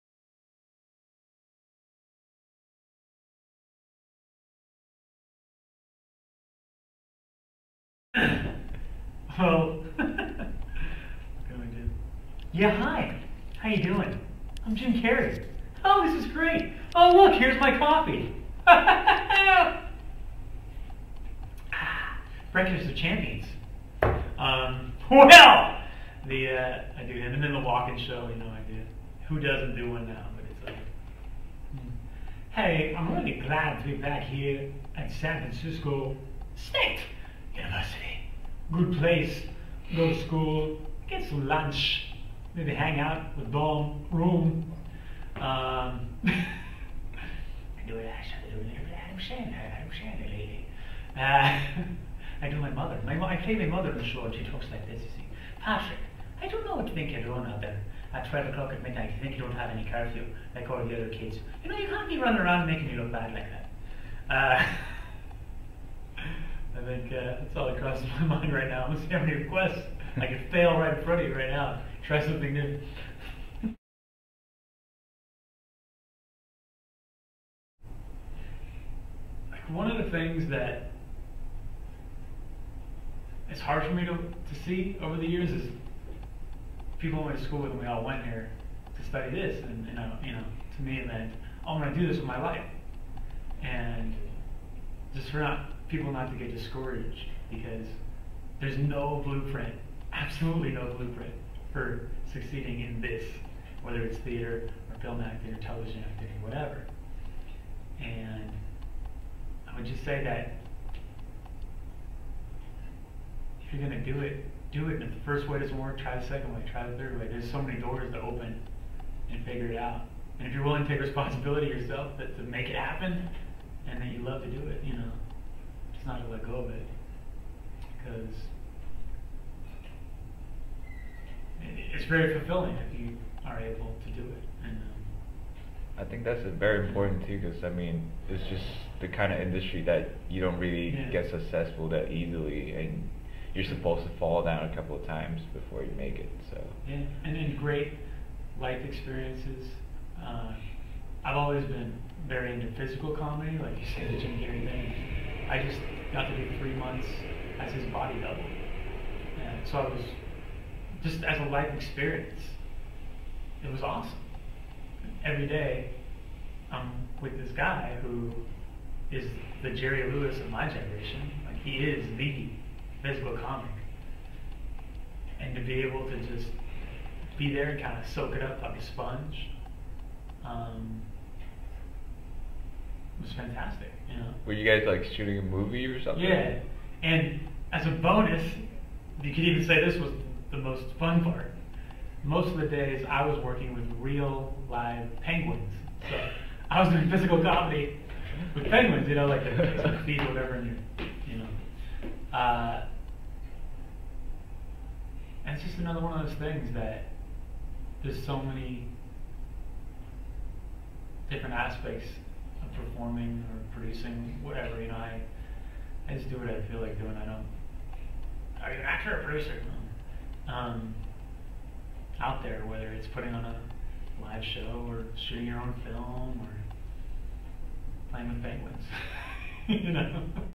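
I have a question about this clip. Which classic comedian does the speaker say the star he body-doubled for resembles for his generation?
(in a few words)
Jerry Lewis.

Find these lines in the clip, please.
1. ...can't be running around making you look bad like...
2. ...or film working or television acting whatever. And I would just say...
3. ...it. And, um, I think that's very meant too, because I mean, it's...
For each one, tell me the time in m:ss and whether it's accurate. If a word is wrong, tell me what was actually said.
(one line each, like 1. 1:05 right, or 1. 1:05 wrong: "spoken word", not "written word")
1. 1:01 right
2. 1:44 wrong: "acting", not "working"
3. 2:14 wrong: "important", not "meant".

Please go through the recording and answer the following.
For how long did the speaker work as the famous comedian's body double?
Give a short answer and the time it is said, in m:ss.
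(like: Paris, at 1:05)
3 months, at 2:36.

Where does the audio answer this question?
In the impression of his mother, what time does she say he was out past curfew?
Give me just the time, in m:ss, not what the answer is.
0:58.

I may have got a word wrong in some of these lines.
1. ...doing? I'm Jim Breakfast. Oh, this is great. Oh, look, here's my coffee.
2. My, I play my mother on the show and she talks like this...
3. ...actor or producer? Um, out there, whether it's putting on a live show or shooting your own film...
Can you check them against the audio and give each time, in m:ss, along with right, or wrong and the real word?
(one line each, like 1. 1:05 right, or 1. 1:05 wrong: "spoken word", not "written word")
1. 0:13 wrong: "Carrey", not "Breakfast"
2. 0:53 right
3. 3:38 right.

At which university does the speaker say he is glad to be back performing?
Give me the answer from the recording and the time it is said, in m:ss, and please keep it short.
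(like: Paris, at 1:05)
San Francisco State University, at 0:35.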